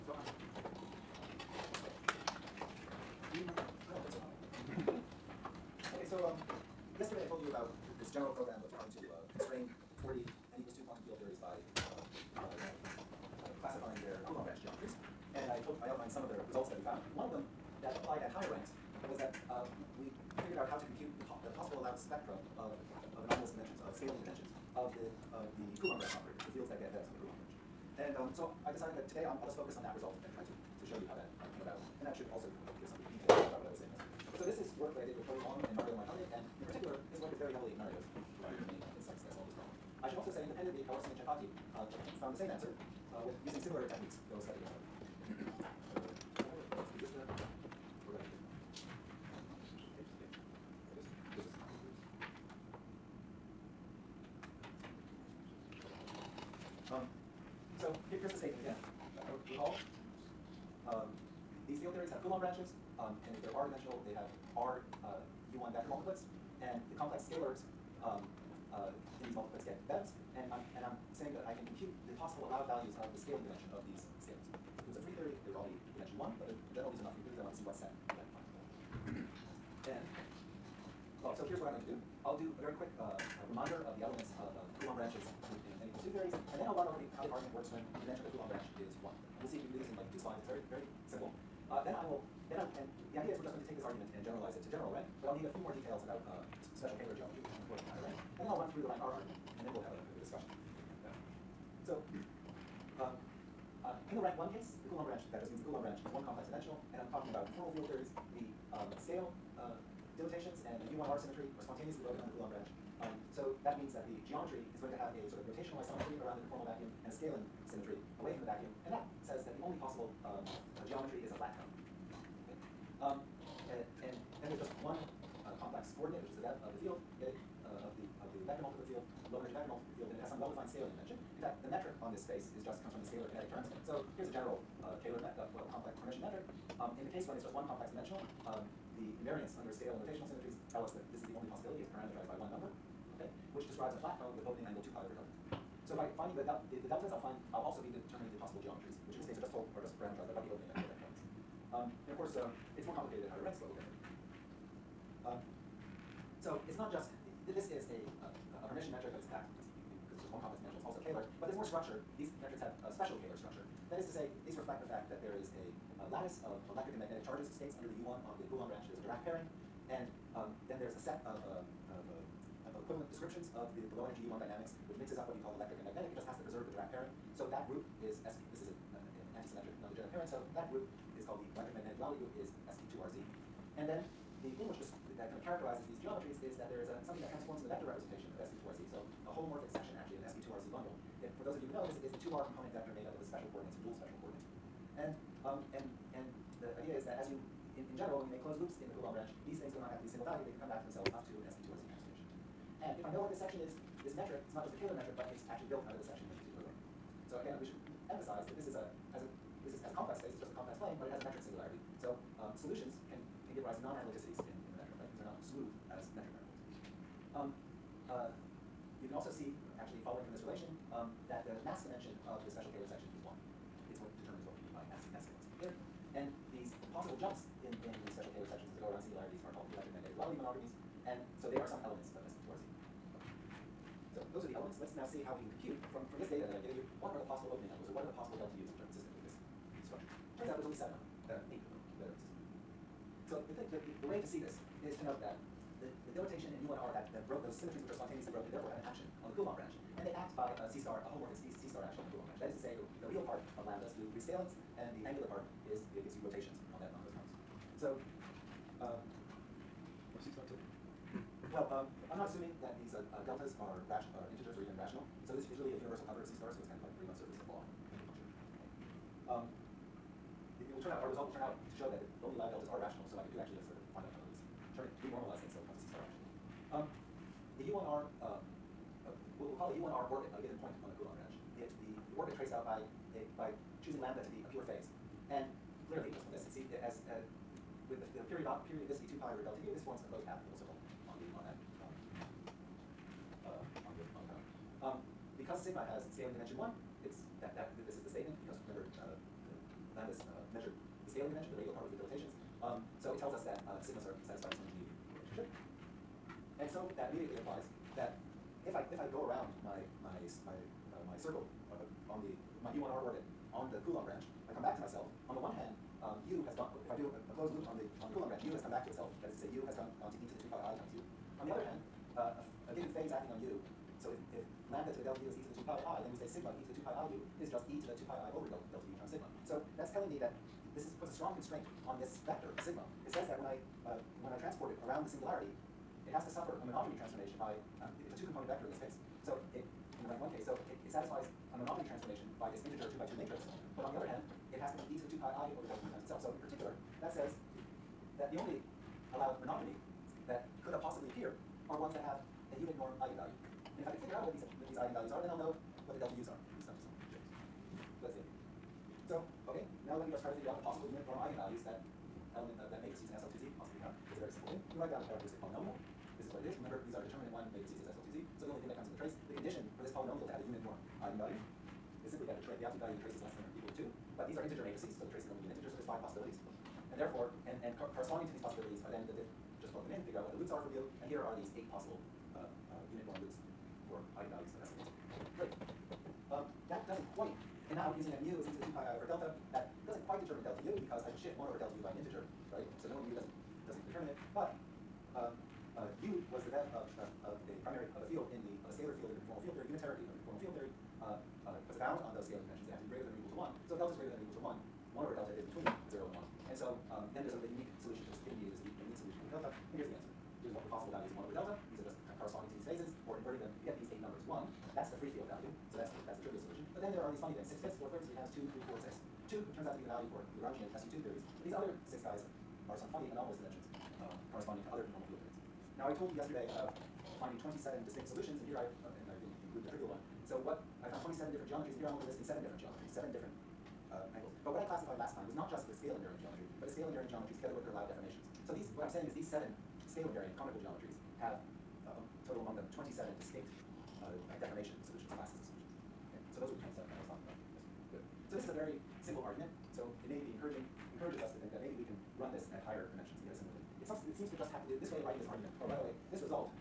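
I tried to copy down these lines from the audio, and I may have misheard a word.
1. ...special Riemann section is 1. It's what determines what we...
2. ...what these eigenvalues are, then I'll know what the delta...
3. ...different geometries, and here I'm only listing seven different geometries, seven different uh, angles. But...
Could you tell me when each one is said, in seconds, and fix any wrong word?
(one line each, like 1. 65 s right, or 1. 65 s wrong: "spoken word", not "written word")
1. 222 s wrong: "Kähler", not "Riemann"
2. 354 s right
3. 431 s right.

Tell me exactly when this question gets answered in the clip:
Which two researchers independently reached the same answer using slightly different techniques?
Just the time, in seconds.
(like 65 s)
40 s.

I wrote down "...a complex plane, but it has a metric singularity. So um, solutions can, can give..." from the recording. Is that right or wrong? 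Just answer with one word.
right.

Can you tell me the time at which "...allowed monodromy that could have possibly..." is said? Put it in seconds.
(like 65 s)
349 s.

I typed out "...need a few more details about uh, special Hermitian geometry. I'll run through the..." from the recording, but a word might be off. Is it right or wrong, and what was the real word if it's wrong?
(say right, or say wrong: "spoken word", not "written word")
wrong: "Kähler", not "Hermitian".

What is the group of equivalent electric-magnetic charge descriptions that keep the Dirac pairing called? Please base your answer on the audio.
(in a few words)
electric magnetic duality group.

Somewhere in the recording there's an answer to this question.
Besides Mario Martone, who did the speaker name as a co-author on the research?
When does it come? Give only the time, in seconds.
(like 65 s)
35 s.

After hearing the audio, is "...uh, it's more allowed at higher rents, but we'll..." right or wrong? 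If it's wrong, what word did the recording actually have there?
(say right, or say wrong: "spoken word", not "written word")
wrong: "complicated", not "allowed".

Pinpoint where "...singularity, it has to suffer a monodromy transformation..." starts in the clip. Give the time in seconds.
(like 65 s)
335 s.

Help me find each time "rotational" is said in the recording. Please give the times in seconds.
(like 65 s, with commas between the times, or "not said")
115 s, 140 s.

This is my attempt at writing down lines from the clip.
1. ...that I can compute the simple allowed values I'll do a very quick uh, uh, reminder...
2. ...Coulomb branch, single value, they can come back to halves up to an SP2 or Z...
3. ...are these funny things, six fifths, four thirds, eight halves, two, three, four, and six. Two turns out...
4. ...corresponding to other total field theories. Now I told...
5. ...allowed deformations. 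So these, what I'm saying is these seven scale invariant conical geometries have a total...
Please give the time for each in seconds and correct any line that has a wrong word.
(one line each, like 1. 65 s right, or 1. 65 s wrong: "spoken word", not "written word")
1. 71 s wrong: "possible", not "simple"
2. 198 s wrong: "themselves", not "halves"
3. 417 s wrong: "three", not "eight"
4. 424 s wrong: "conformal", not "total"
5. 437 s right.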